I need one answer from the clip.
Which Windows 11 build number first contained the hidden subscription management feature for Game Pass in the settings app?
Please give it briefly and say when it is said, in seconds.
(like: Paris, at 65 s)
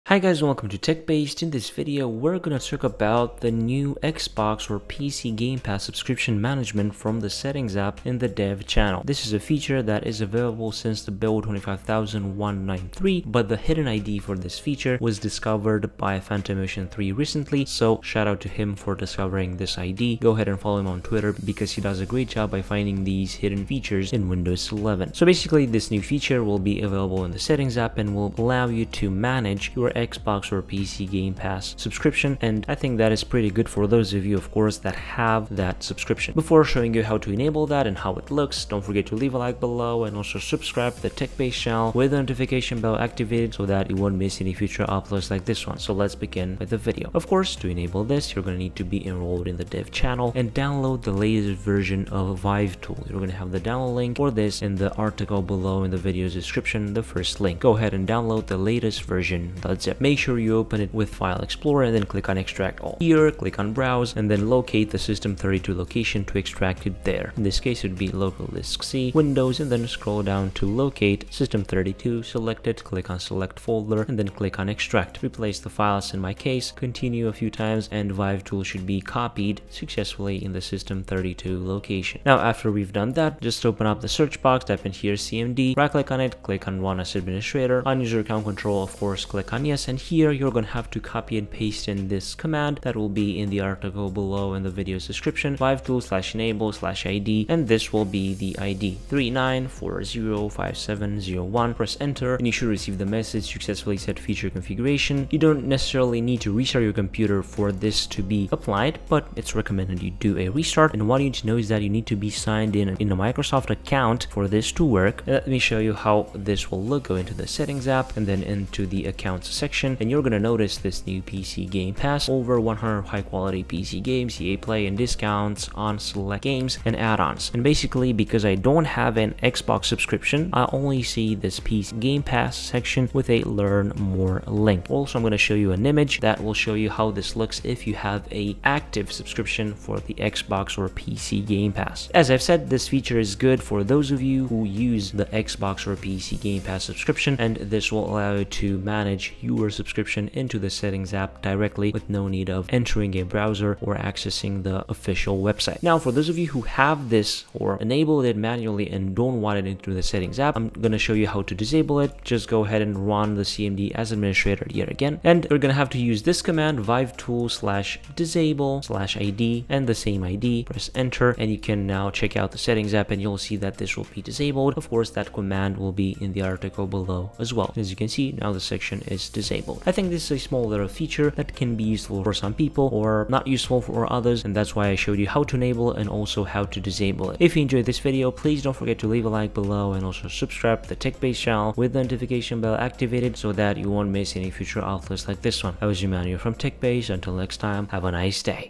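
25193, at 11 s.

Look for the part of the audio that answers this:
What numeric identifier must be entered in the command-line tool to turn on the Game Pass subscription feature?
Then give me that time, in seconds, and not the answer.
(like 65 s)
99 s.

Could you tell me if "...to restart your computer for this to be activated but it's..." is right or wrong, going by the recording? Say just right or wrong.
wrong.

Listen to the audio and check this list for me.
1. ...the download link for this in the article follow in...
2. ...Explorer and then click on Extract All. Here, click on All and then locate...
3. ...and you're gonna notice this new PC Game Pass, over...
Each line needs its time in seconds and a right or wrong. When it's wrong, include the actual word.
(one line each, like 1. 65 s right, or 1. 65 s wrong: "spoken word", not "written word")
1. 53 s wrong: "below", not "follow"
2. 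61 s wrong: "Browse", not "All"
3. 119 s right.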